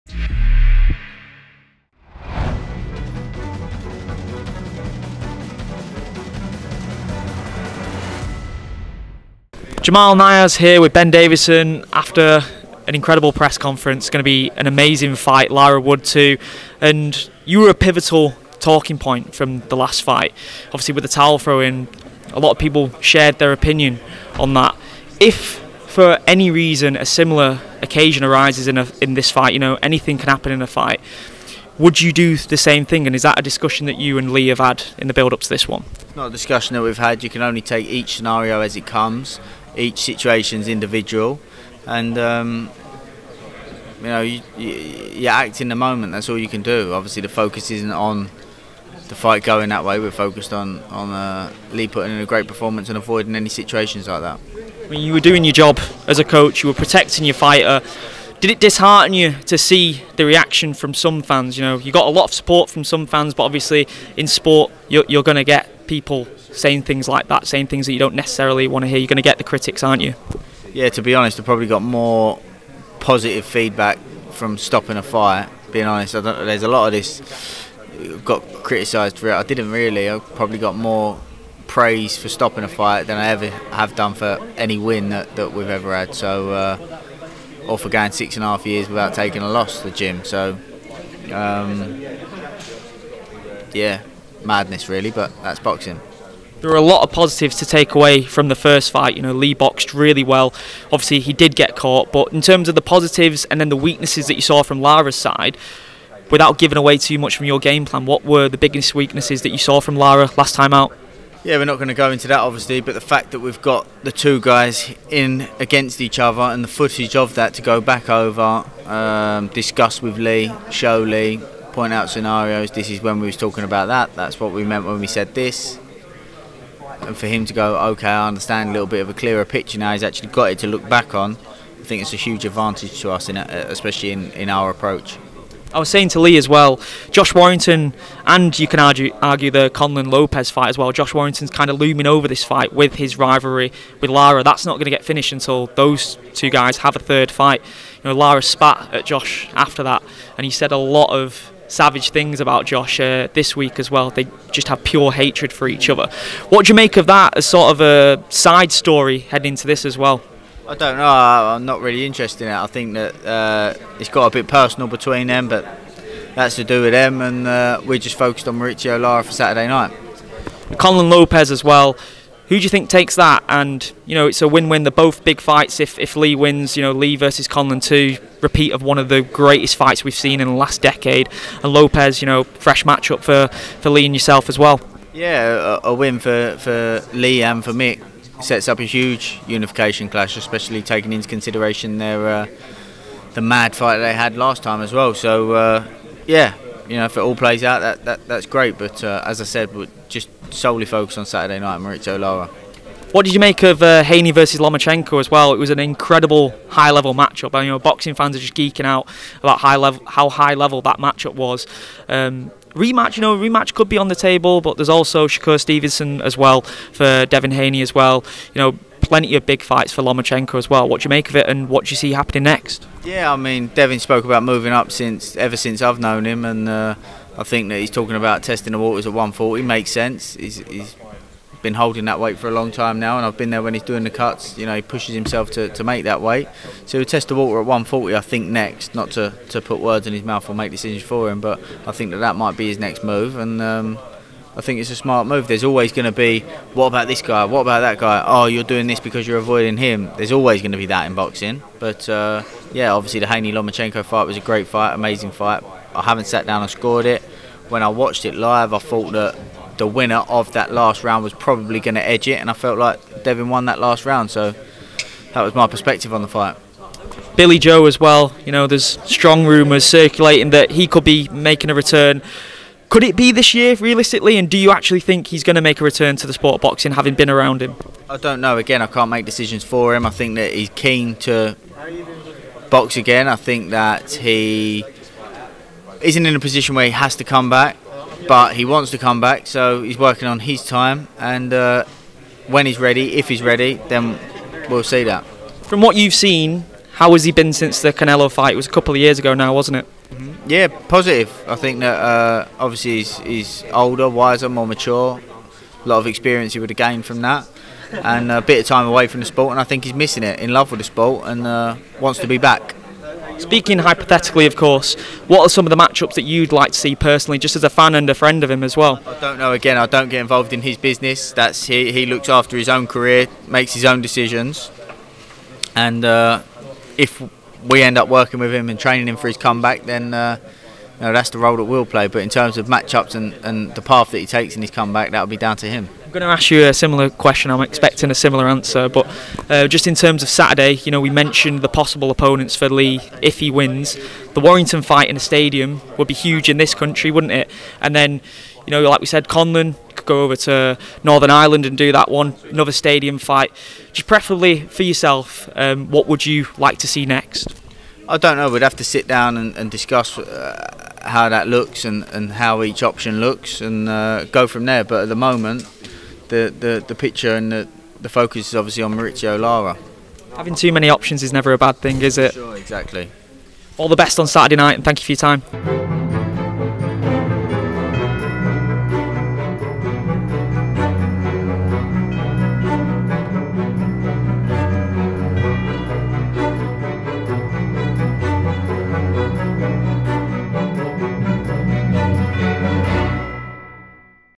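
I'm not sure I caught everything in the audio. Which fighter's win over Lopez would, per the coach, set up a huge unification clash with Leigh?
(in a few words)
Mick.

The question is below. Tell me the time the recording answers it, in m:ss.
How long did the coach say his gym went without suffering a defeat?
1:28.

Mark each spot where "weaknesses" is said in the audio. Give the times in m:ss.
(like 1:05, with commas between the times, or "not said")
1:43, 1:48.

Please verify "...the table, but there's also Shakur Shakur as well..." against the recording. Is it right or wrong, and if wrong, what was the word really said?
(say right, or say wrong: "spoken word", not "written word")
wrong: "Stevenson", not "Shakur".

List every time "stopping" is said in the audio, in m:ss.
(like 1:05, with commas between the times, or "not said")
1:14, 1:22.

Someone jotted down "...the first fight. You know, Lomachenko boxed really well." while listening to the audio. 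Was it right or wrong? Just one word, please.
wrong.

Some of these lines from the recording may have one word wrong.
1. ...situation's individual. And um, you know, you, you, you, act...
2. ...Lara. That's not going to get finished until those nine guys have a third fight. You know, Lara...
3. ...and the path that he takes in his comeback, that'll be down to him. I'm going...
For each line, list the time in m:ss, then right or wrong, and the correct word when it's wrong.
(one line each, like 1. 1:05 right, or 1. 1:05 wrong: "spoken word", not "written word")
1. 0:40 right
2. 2:24 wrong: "two", not "nine"
3. 5:33 right.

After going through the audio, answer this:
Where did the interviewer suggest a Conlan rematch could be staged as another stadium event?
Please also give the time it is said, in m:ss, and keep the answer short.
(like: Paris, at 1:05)
Northern Ireland, at 5:51.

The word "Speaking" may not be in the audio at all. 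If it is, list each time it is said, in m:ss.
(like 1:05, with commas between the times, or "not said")
5:13.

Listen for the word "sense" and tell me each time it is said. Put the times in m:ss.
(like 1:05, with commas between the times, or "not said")
3:49.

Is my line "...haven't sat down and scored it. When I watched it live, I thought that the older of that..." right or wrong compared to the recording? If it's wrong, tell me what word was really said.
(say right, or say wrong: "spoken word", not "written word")
wrong: "winner", not "older".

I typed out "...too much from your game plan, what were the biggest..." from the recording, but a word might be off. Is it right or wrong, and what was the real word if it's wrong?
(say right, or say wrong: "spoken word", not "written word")
right.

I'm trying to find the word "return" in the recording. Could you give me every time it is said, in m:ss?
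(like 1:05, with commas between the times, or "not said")
4:31, 4:35.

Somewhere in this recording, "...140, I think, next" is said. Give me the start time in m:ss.
3:57.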